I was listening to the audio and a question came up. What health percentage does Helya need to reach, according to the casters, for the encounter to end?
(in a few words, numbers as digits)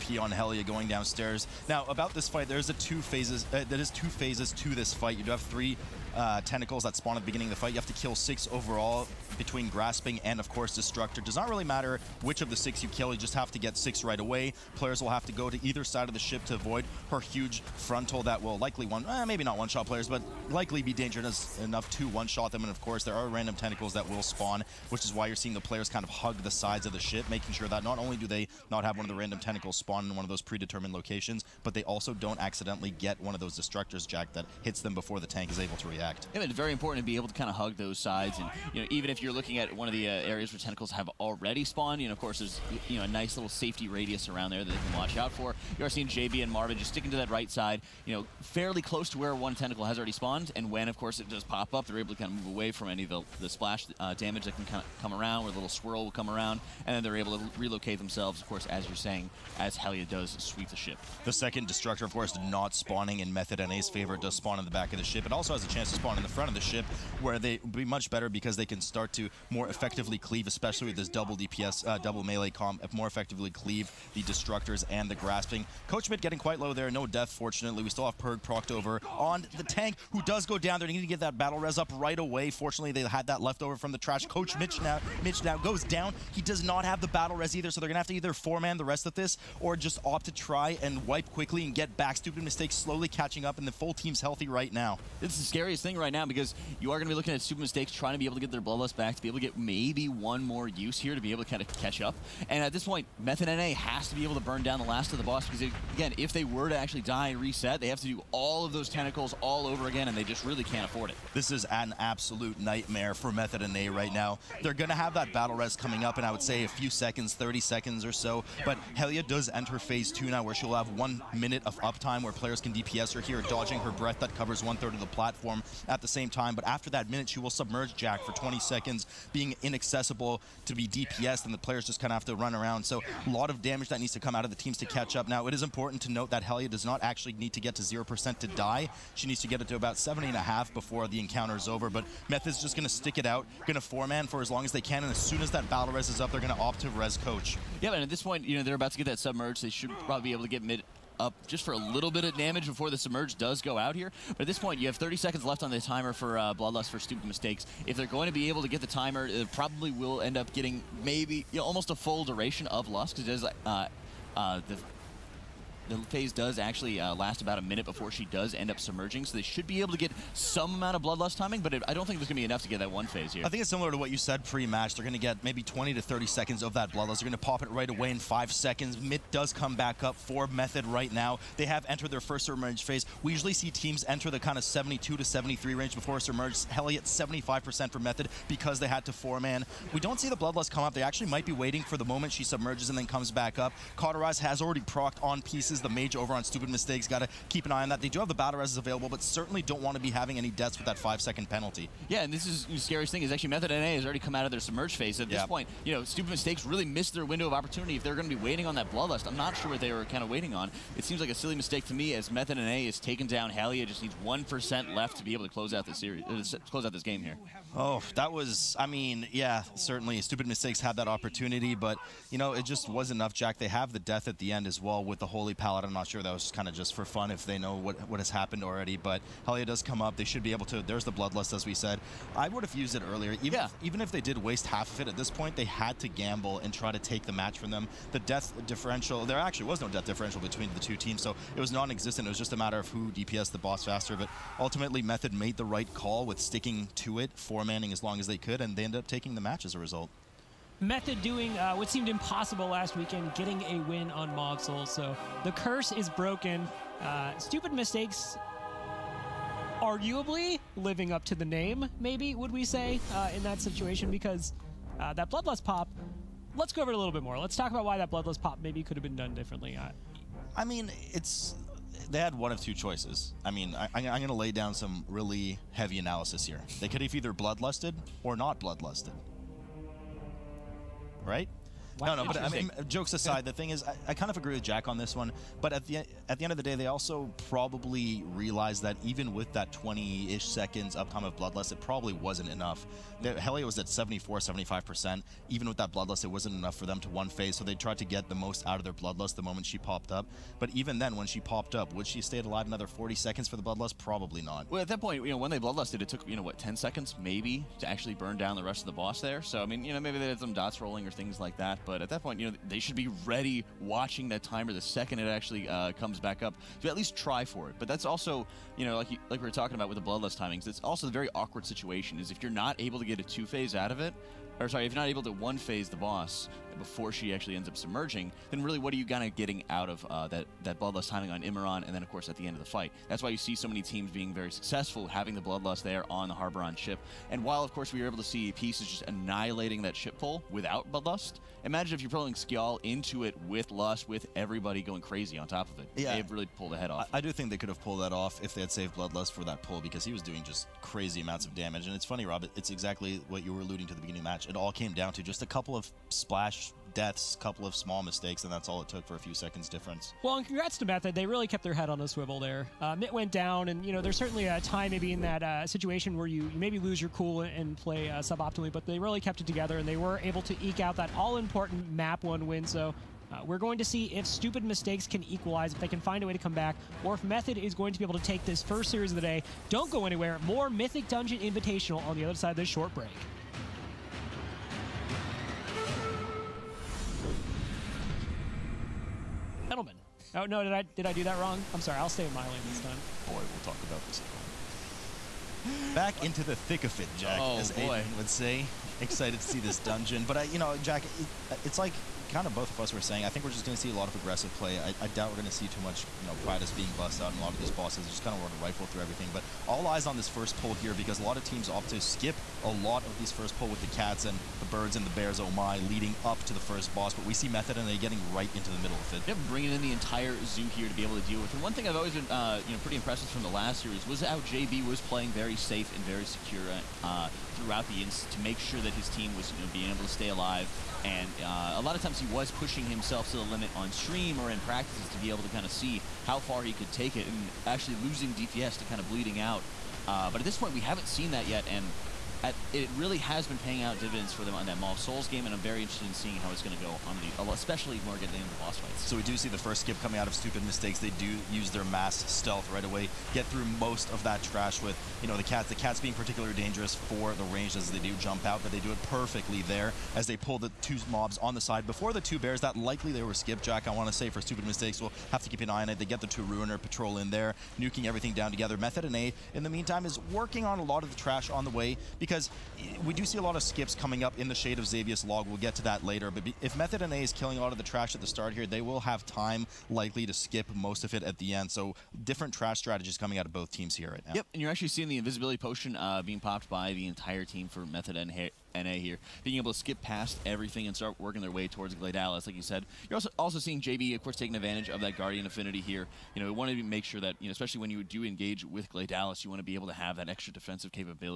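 70.5%.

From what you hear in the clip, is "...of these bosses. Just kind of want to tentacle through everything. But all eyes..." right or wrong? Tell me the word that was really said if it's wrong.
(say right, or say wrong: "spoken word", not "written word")
wrong: "rifle", not "tentacle".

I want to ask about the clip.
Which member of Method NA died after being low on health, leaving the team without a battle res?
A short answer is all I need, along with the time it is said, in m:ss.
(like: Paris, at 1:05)
Coach Mitch, at 1:24.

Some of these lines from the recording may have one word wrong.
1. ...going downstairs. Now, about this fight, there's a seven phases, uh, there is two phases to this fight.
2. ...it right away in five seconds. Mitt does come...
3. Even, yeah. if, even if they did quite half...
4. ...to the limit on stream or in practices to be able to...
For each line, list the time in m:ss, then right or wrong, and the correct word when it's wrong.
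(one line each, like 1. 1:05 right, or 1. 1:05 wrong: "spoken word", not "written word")
1. 0:00 wrong: "two", not "seven"
2. 2:57 right
3. 3:53 wrong: "waste", not "quite"
4. 7:13 right.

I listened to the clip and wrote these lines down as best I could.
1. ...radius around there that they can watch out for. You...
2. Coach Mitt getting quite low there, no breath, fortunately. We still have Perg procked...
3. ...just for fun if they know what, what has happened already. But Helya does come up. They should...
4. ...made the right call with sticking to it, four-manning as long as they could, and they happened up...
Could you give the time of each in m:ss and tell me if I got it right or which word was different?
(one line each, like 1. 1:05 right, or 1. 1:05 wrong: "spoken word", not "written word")
1. 0:43 right
2. 1:15 wrong: "death", not "breath"
3. 3:46 right
4. 4:05 wrong: "ended", not "happened".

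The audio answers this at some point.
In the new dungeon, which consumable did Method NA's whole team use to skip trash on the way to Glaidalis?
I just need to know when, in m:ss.
8:05.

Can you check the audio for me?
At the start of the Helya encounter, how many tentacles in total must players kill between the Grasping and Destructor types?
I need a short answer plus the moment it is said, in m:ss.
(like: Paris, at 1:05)
6, at 0:08.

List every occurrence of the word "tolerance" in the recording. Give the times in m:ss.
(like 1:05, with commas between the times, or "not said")
not said.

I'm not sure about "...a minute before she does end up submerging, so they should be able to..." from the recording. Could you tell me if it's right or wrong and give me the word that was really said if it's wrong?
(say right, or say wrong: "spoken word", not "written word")
right.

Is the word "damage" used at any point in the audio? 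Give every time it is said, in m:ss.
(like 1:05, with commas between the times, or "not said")
0:54, 2:13, 2:32, 5:51.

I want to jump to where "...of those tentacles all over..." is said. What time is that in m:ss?
1:48.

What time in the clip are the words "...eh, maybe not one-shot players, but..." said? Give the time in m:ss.
0:19.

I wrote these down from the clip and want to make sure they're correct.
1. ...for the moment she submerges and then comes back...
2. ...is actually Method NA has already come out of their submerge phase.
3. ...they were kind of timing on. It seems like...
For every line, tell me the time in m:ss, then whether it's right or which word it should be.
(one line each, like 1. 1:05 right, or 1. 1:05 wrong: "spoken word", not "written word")
1. 3:11 right
2. 3:23 right
3. 3:29 wrong: "waiting", not "timing".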